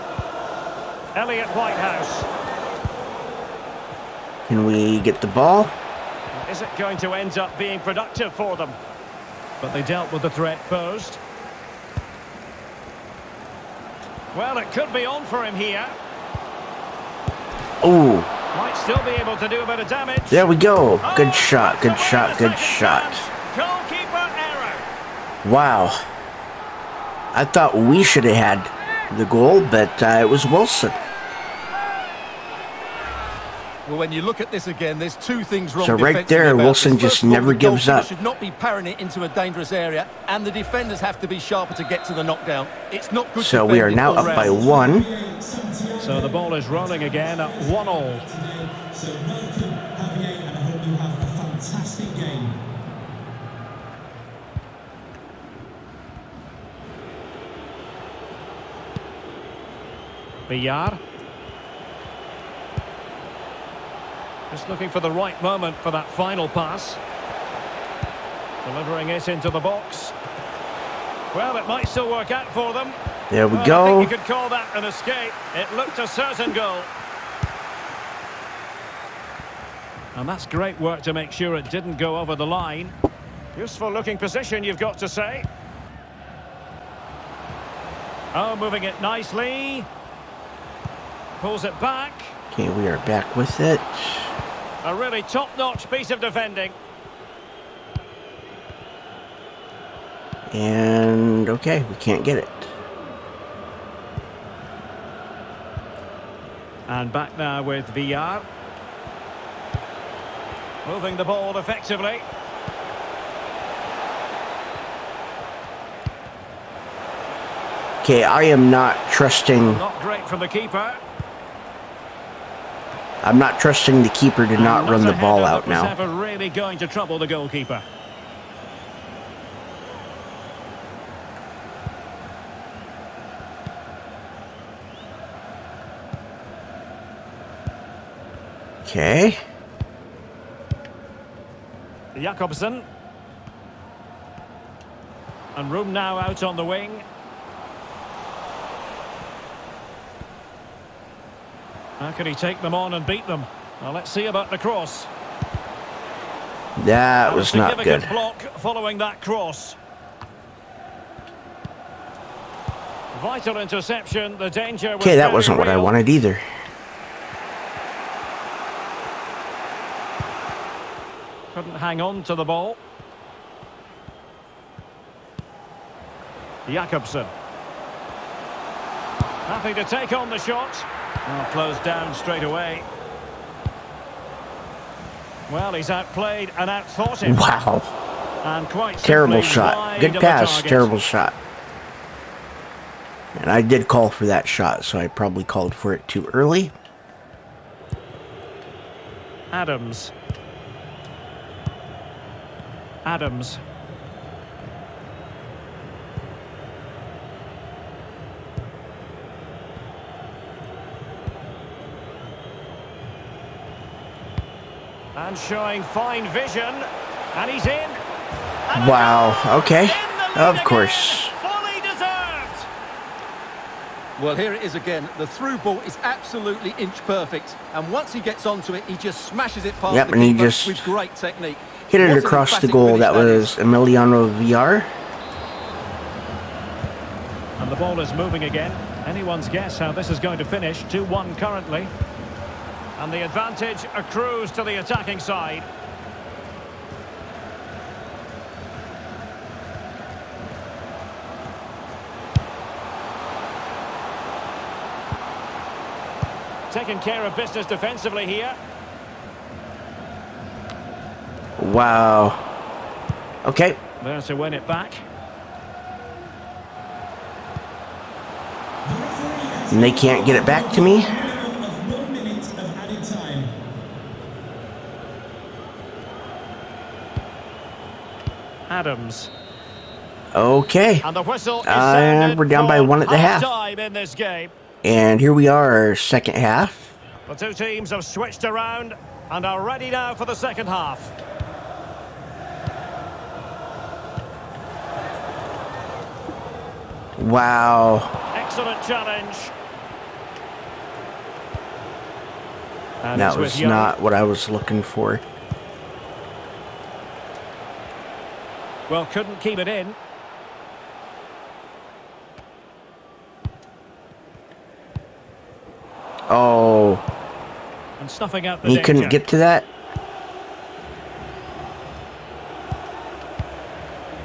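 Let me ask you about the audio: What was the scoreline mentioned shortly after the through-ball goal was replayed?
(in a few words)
2-1.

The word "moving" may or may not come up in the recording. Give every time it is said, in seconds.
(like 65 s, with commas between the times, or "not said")
88 s, 110 s, 238 s.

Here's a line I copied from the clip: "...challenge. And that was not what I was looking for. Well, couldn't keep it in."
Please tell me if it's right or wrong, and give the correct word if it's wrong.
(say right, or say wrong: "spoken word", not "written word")
right.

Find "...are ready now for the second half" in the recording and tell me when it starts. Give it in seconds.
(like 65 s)
289 s.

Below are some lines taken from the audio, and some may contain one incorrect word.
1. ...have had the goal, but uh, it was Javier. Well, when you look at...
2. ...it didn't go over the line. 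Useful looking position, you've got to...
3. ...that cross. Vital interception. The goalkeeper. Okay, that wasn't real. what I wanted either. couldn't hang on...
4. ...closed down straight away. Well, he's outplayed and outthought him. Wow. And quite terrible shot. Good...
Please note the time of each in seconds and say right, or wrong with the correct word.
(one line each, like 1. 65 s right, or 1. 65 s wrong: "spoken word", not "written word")
1. 28 s wrong: "Wilson", not "Javier"
2. 81 s right
3. 158 s wrong: "danger", not "goalkeeper"
4. 181 s right.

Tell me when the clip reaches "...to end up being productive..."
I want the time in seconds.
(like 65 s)
6 s.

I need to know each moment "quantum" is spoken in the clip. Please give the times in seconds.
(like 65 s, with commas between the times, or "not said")
not said.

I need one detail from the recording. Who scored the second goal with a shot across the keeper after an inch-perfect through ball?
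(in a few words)
Emiliano Villar.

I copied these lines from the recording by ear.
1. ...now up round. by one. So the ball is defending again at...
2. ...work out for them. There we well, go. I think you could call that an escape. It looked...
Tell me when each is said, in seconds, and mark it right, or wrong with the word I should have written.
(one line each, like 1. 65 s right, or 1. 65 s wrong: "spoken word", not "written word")
1. 43 s wrong: "rolling", not "defending"
2. 72 s right.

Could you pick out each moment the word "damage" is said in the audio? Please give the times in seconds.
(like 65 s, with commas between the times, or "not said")
19 s.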